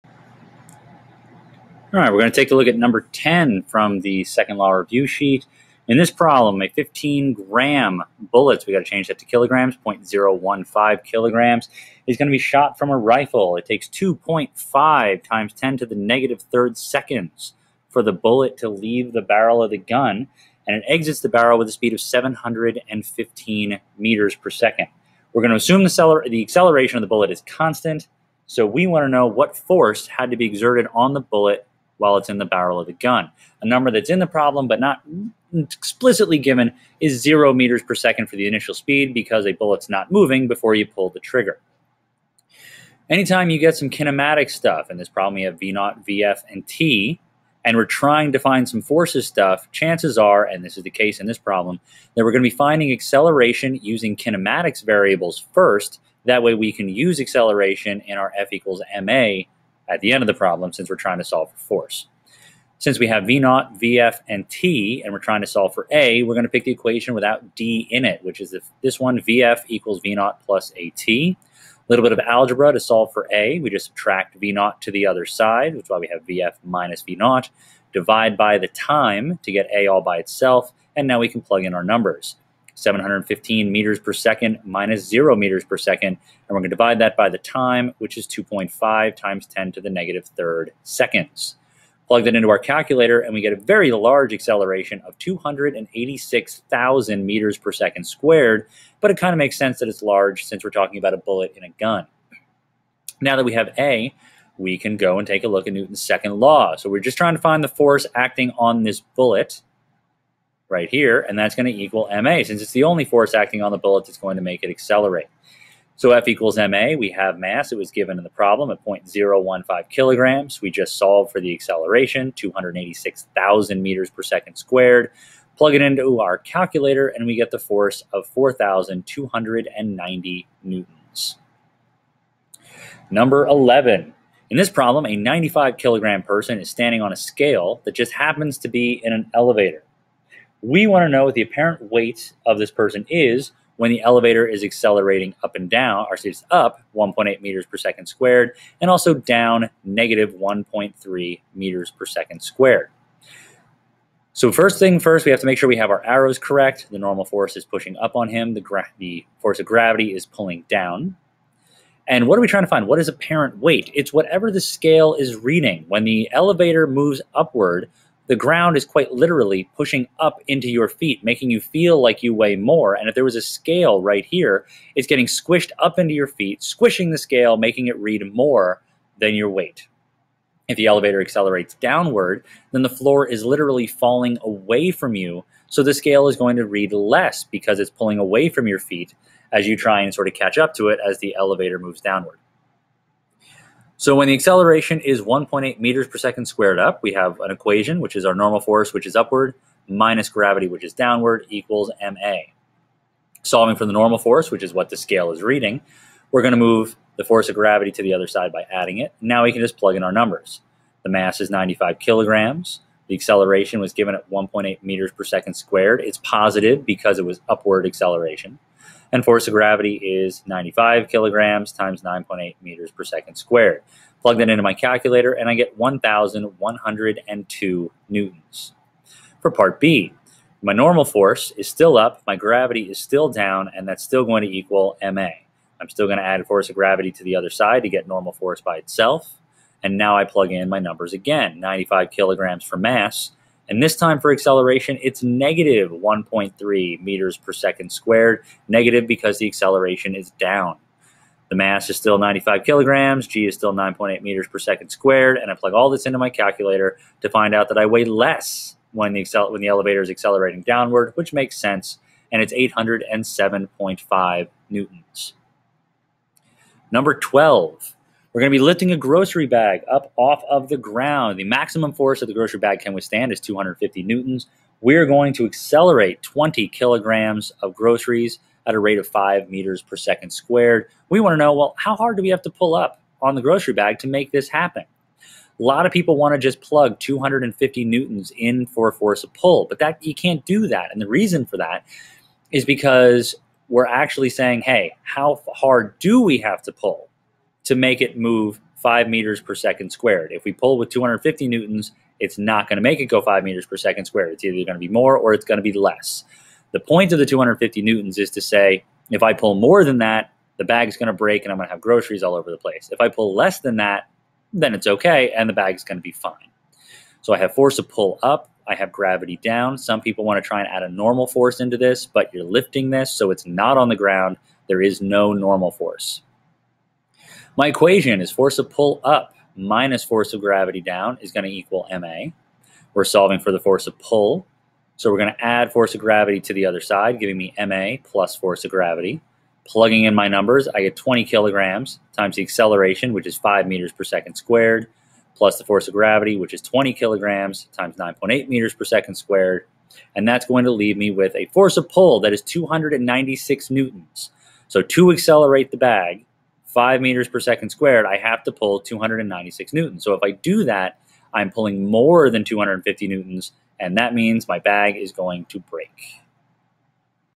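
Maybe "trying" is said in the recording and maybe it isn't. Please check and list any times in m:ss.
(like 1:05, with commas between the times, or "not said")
0:47, 1:00, 1:05, 1:47, 2:42.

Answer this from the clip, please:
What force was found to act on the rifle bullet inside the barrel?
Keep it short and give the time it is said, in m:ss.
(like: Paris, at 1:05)
4,290 newtons, at 2:08.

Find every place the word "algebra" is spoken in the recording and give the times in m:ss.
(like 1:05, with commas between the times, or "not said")
1:12.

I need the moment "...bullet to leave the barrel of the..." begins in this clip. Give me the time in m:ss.
0:18.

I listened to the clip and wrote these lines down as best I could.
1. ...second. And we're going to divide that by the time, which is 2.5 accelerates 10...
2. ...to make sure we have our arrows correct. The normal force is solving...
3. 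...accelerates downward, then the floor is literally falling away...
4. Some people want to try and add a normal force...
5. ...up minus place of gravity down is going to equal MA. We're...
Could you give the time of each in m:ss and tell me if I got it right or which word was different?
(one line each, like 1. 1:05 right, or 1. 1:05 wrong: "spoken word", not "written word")
1. 1:25 wrong: "times", not "accelerates"
2. 2:35 wrong: "pushing", not "solving"
3. 3:01 right
4. 5:19 right
5. 5:29 wrong: "force", not "place".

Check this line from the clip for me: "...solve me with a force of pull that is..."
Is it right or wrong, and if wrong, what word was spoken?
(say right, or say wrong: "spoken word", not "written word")
wrong: "leave", not "solve".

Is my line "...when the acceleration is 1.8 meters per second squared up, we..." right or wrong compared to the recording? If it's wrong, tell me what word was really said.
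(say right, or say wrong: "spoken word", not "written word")
right.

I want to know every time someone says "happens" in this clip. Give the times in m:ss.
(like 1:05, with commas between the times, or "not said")
2:18, 4:44.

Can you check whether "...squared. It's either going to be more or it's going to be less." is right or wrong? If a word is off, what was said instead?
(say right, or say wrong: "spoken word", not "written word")
right.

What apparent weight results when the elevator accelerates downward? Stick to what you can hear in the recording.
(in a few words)
807.5 newtons.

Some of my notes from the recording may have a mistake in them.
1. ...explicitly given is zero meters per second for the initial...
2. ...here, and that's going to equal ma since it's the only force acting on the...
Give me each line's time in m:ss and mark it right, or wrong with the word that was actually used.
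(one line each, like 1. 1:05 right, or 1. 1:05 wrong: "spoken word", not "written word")
1. 0:35 right
2. 1:50 right.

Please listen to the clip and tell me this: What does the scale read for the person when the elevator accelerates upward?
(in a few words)
1,102 newtons.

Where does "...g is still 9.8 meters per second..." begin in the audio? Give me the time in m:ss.
4:13.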